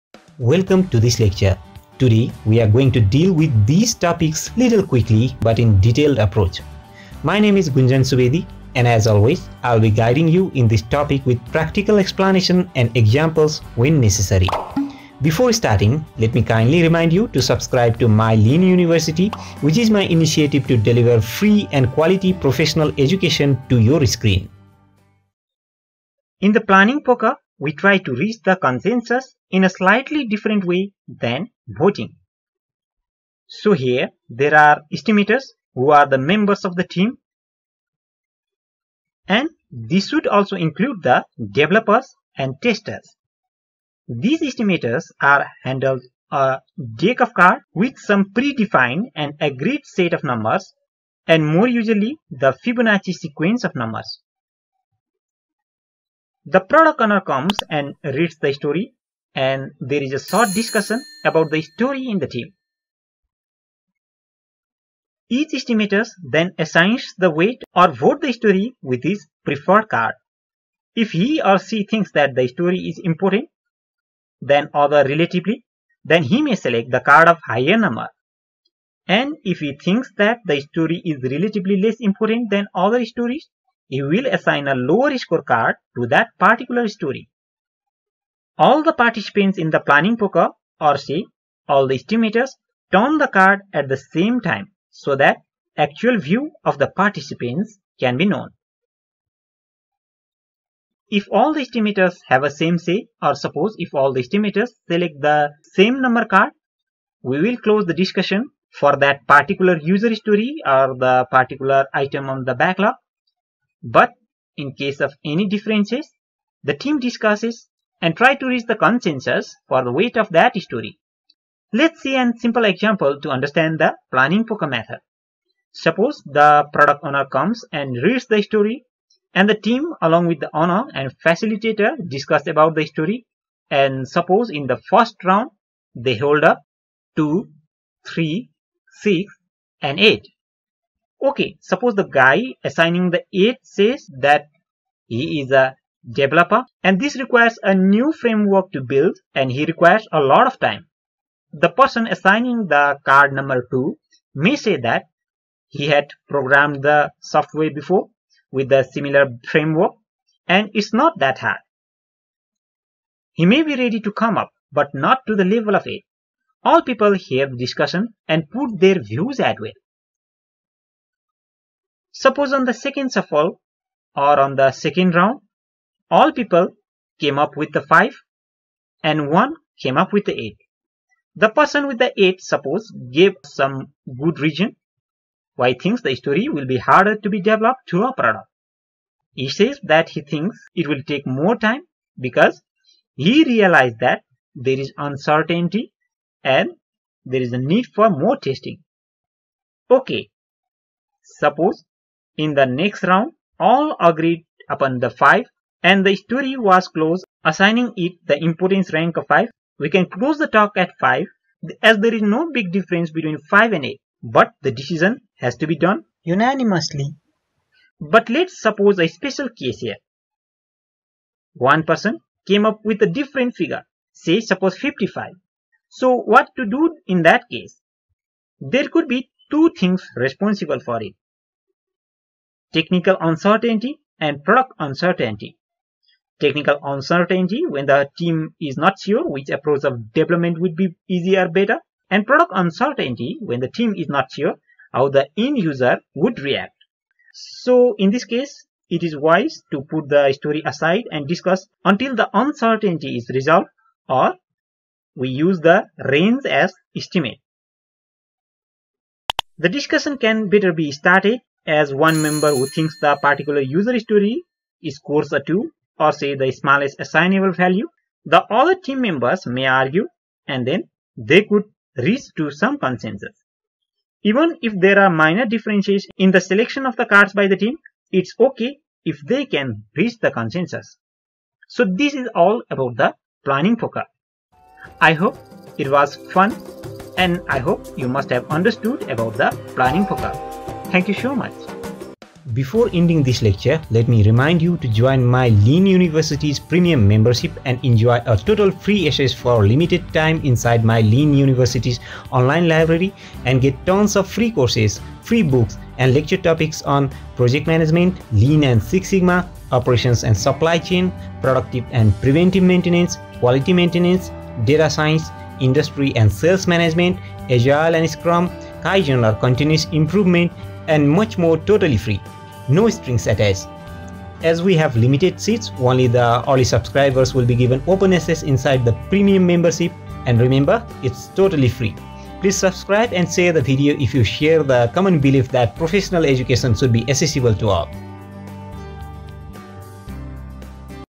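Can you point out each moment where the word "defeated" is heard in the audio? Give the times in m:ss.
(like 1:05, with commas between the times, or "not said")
not said.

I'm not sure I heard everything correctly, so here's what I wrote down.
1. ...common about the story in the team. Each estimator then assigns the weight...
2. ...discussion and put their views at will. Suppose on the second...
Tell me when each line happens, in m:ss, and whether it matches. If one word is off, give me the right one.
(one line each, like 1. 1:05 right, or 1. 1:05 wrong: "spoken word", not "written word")
1. 1:00 wrong: "discussion", not "common"
2. 2:47 right.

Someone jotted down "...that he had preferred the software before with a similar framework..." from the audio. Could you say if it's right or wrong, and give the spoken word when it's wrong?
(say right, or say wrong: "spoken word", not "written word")
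wrong: "programmed", not "preferred".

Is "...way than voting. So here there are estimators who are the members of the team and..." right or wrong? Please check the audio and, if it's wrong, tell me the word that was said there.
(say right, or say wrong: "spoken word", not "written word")
right.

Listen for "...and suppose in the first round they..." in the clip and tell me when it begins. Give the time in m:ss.
2:13.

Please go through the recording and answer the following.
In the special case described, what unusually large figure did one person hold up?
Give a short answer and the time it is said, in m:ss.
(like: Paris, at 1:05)
55, at 3:44.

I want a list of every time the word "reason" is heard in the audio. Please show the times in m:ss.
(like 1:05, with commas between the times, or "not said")
3:04.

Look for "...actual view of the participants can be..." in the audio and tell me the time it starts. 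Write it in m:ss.
1:35.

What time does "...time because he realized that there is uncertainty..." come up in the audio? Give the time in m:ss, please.
3:11.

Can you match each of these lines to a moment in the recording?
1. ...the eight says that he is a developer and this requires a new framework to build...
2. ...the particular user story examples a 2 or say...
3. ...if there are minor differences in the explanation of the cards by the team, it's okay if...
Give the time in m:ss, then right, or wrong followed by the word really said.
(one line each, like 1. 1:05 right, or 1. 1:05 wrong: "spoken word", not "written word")
1. 2:23 right
2. 4:22 wrong: "scores", not "examples"
3. 4:34 wrong: "selection", not "explanation".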